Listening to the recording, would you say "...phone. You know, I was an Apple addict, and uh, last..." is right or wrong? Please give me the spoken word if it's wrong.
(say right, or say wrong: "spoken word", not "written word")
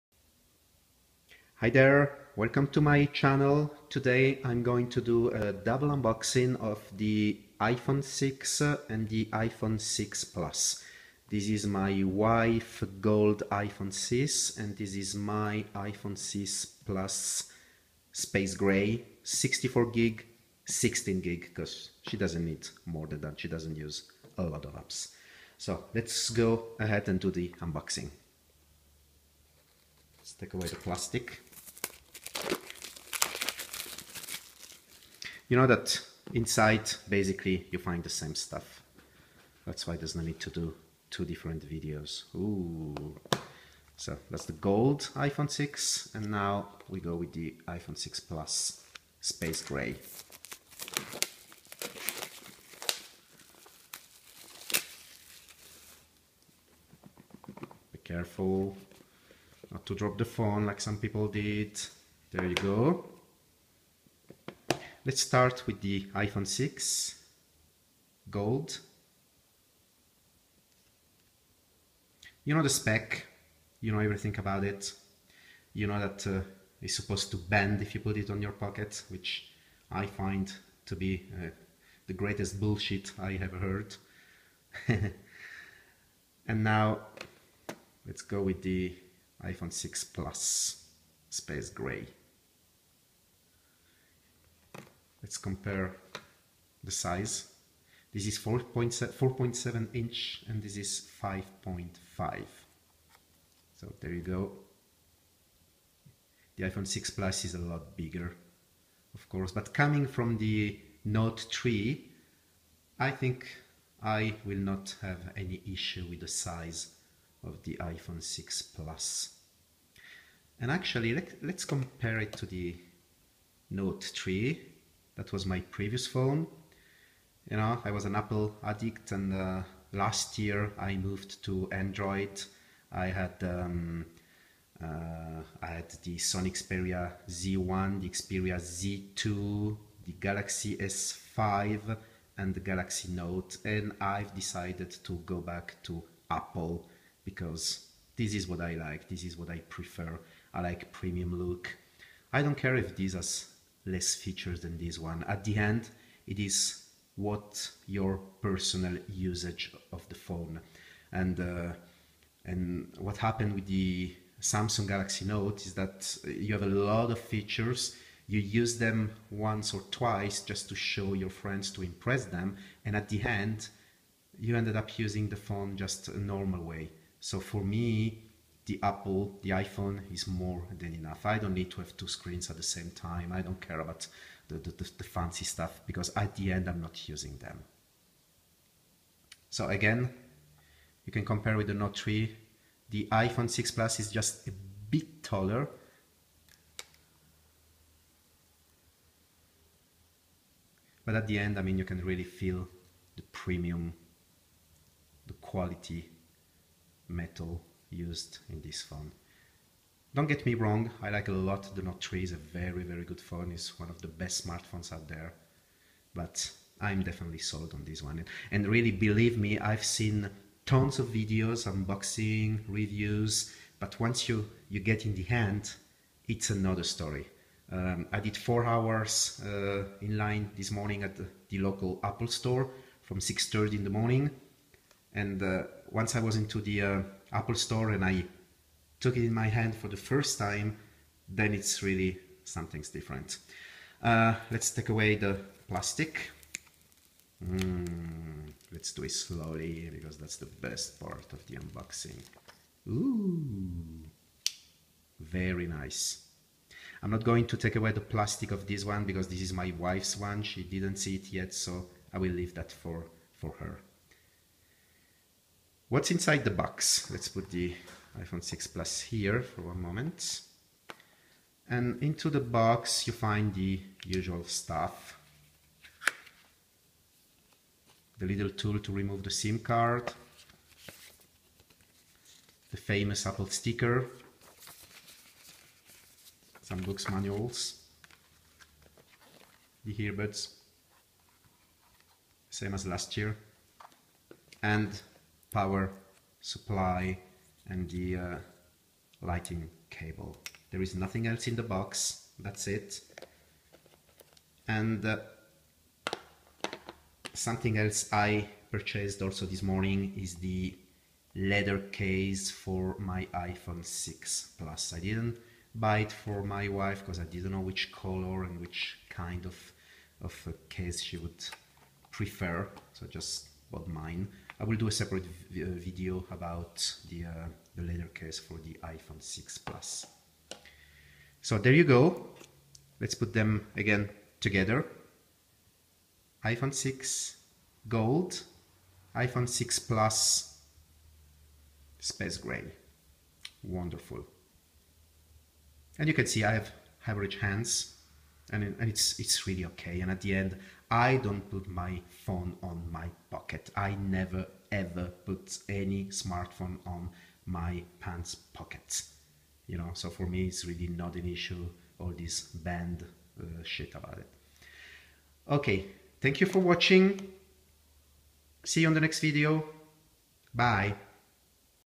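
right.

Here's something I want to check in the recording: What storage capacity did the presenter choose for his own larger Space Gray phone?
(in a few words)
64 GB.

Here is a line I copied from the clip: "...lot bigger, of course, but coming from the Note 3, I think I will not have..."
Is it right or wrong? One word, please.
right.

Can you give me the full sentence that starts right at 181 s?
I don't need to have two screens at the same time.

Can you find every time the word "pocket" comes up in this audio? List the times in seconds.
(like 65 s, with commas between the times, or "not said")
78 s, 353 s, 358 s.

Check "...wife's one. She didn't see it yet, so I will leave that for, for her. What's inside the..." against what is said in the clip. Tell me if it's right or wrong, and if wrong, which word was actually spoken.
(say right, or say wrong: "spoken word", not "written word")
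right.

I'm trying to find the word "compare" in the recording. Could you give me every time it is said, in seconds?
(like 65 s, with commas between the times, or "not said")
95 s, 121 s, 191 s.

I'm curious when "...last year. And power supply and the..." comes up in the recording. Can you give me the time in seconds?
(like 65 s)
292 s.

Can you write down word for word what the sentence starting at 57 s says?
Be careful not to drop the phone like some people did.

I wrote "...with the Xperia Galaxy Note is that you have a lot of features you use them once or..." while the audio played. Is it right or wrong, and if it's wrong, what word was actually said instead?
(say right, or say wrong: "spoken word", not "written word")
wrong: "Samsung", not "Xperia".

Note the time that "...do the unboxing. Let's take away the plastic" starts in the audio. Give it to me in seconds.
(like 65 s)
27 s.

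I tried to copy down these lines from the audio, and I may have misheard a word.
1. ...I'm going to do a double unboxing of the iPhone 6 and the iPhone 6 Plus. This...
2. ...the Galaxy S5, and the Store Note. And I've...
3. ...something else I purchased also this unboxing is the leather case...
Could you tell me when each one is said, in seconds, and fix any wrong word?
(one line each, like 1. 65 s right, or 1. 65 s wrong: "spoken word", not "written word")
1. 4 s right
2. 140 s wrong: "Galaxy", not "Store"
3. 307 s wrong: "morning", not "unboxing".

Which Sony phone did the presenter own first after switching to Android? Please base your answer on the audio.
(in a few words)
Xperia Z1.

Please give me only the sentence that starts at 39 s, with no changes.
That's why there's no need to do two different videos.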